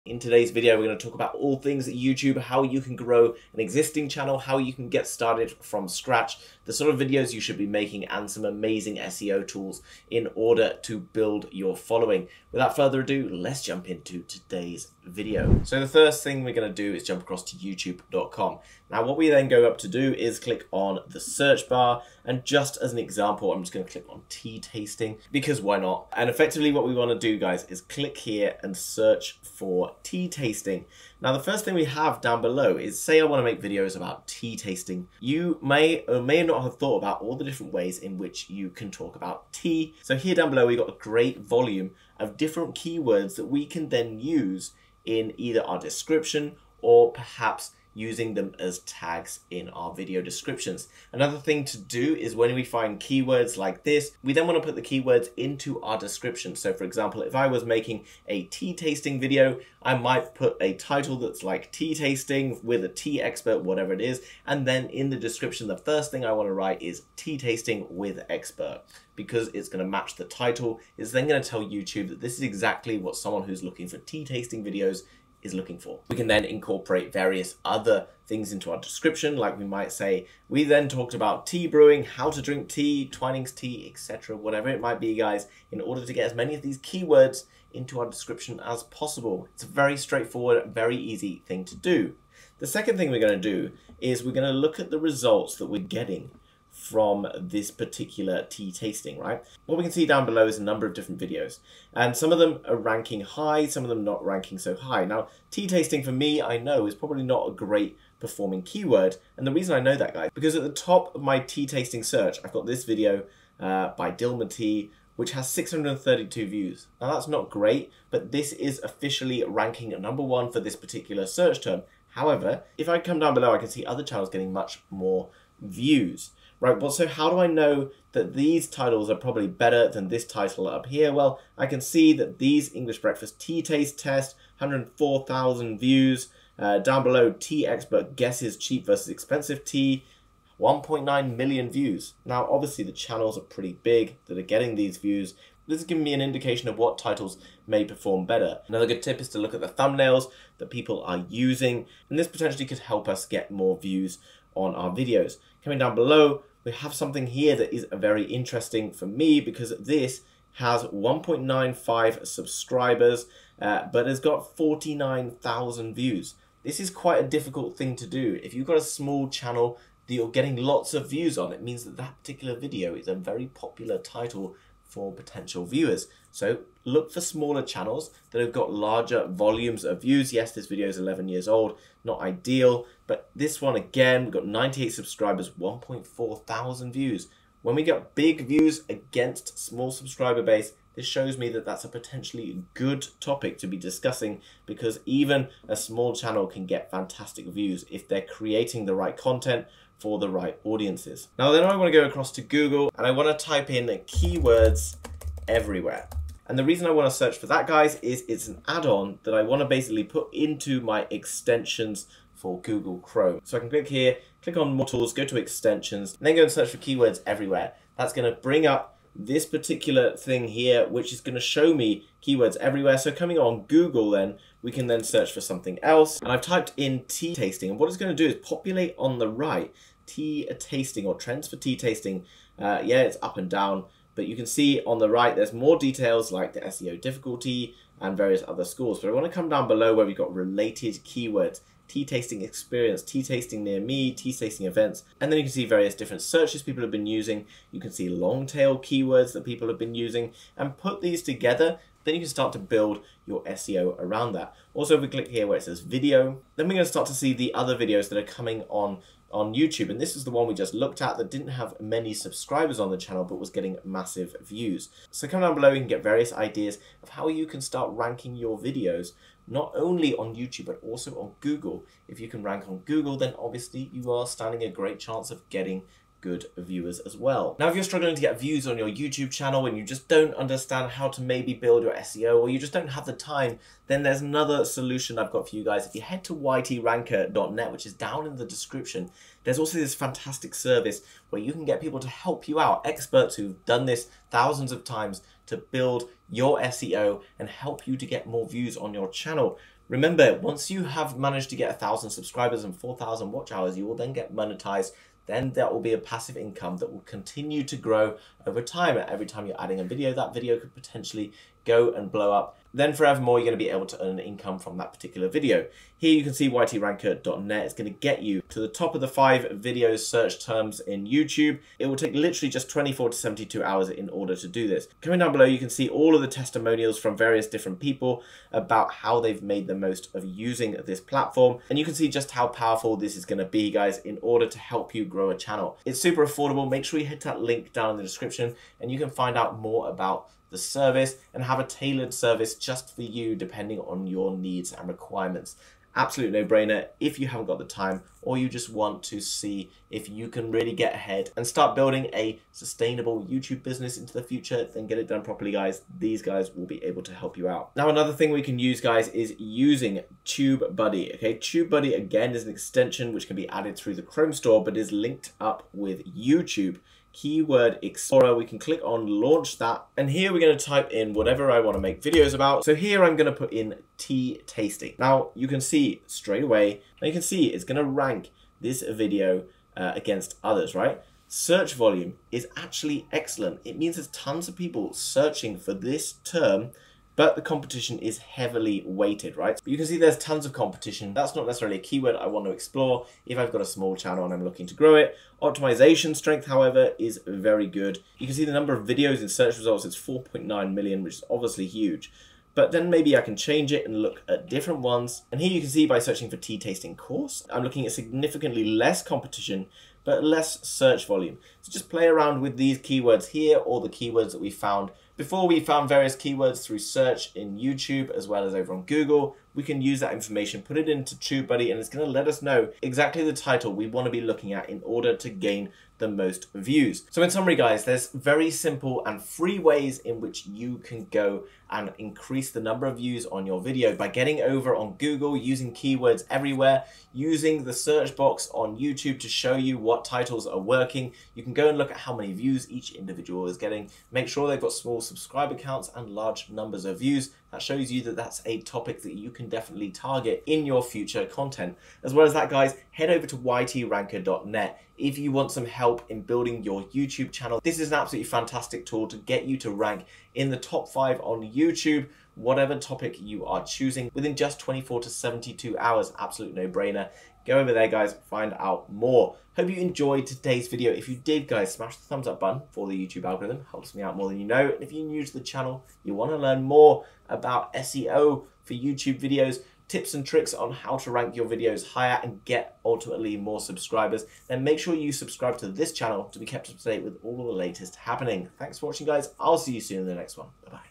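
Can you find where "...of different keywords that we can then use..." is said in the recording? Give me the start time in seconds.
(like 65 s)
42 s.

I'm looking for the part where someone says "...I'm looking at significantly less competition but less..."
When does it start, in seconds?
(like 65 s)
407 s.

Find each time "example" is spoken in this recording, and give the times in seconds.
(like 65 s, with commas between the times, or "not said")
22 s, 56 s.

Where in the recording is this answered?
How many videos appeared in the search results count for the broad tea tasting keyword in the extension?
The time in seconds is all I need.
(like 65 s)
399 s.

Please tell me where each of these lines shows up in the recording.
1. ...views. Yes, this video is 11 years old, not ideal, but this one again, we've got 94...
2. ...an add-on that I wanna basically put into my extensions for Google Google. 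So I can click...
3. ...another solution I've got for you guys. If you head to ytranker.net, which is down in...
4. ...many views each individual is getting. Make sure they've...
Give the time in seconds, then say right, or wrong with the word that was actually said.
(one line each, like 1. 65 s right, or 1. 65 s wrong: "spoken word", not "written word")
1. 180 s wrong: "98", not "94"
2. 208 s wrong: "Chrome", not "Google"
3. 284 s right
4. 442 s right.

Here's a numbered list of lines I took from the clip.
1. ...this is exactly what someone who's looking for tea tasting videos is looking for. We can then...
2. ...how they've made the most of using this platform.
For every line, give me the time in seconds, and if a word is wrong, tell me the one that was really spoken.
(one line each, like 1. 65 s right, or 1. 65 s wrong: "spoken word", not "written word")
1. 72 s right
2. 328 s right.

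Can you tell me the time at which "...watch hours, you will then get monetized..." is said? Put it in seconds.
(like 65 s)
303 s.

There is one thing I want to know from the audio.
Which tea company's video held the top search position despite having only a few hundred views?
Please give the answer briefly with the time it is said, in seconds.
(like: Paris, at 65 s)
Dilmah Tea, at 114 s.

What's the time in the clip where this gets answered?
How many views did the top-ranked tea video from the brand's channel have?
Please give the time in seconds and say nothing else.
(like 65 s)
115 s.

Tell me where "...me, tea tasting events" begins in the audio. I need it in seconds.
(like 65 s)
243 s.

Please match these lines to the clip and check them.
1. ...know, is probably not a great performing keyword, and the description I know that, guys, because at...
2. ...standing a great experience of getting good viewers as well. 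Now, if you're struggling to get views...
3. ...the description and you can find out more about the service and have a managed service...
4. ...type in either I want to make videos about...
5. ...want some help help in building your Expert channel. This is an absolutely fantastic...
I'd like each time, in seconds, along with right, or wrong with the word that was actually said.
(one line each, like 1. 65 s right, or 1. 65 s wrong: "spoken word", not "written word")
1. 106 s wrong: "reason", not "description"
2. 274 s wrong: "chance", not "experience"
3. 337 s wrong: "tailored", not "managed"
4. 370 s wrong: "whatever", not "either"
5. 455 s wrong: "YouTube", not "Expert".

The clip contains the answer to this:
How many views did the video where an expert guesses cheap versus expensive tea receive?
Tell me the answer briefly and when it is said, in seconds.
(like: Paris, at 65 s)
1.9 million, at 140 s.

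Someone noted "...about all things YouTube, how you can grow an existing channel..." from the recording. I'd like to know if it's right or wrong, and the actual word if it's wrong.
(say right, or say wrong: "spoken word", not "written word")
right.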